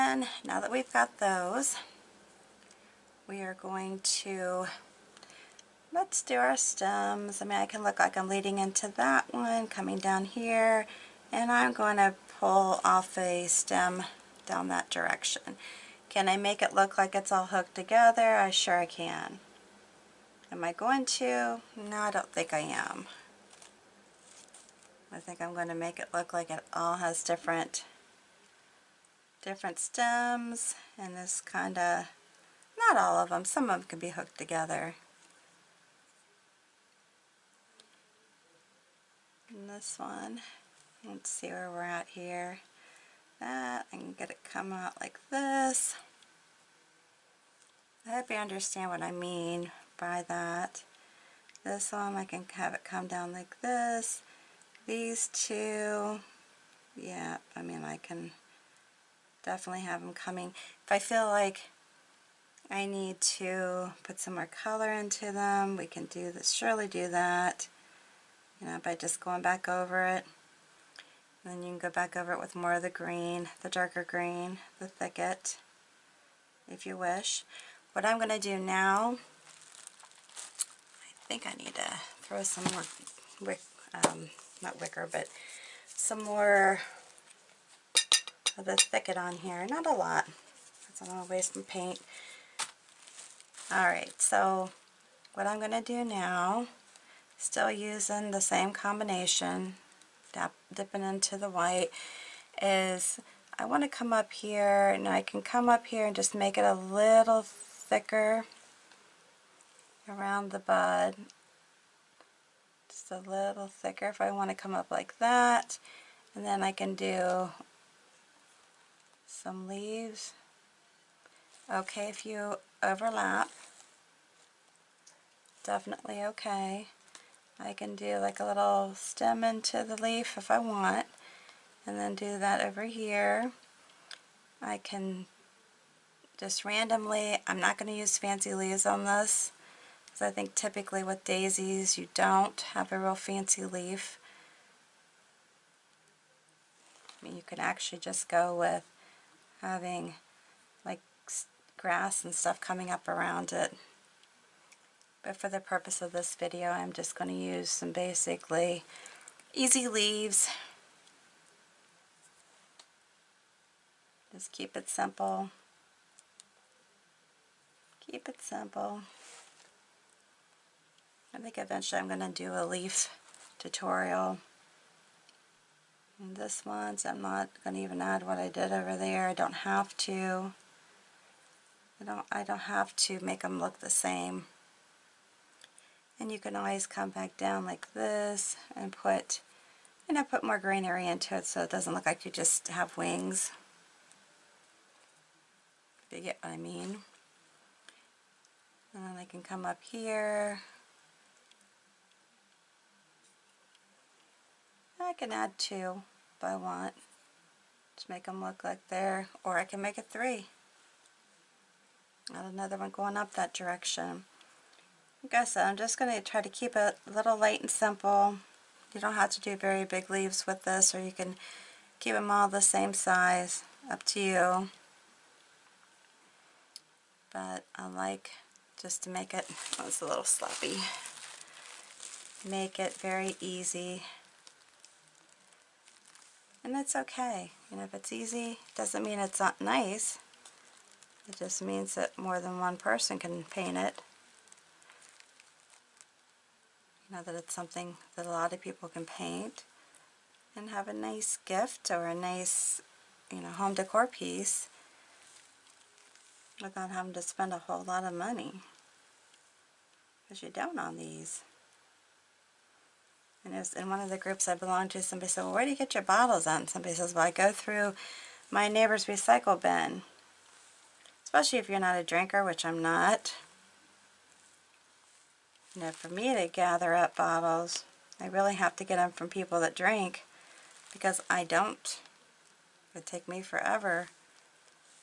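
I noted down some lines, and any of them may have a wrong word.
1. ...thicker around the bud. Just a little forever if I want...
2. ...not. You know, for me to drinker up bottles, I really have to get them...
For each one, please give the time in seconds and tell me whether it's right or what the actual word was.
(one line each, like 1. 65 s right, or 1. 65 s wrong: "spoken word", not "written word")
1. 107 s wrong: "thicker", not "forever"
2. 272 s wrong: "gather", not "drinker".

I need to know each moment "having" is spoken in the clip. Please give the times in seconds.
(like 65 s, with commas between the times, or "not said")
149 s, 256 s.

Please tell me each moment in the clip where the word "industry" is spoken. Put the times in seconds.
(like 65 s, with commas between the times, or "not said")
not said.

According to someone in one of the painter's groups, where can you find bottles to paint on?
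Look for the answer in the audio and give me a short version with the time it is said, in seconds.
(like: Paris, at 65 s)
Neighbor's recycle bin, at 268 s.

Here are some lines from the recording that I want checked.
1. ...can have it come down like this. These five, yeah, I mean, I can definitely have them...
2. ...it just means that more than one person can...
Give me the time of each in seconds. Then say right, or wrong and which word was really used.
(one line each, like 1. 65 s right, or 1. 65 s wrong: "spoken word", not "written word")
1. 52 s wrong: "two", not "five"
2. 241 s right.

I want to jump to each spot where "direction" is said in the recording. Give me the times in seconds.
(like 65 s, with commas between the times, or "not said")
14 s, 213 s.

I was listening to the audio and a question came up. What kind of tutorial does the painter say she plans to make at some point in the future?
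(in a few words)
Leaf tutorial.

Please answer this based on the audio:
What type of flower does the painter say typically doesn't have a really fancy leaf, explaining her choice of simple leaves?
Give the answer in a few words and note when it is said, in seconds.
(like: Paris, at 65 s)
Daisies, at 141 s.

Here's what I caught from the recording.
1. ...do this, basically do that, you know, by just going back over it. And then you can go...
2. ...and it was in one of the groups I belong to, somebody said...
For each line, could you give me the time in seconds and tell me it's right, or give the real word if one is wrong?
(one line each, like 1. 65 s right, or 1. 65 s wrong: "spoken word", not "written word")
1. 66 s wrong: "surely", not "basically"
2. 263 s right.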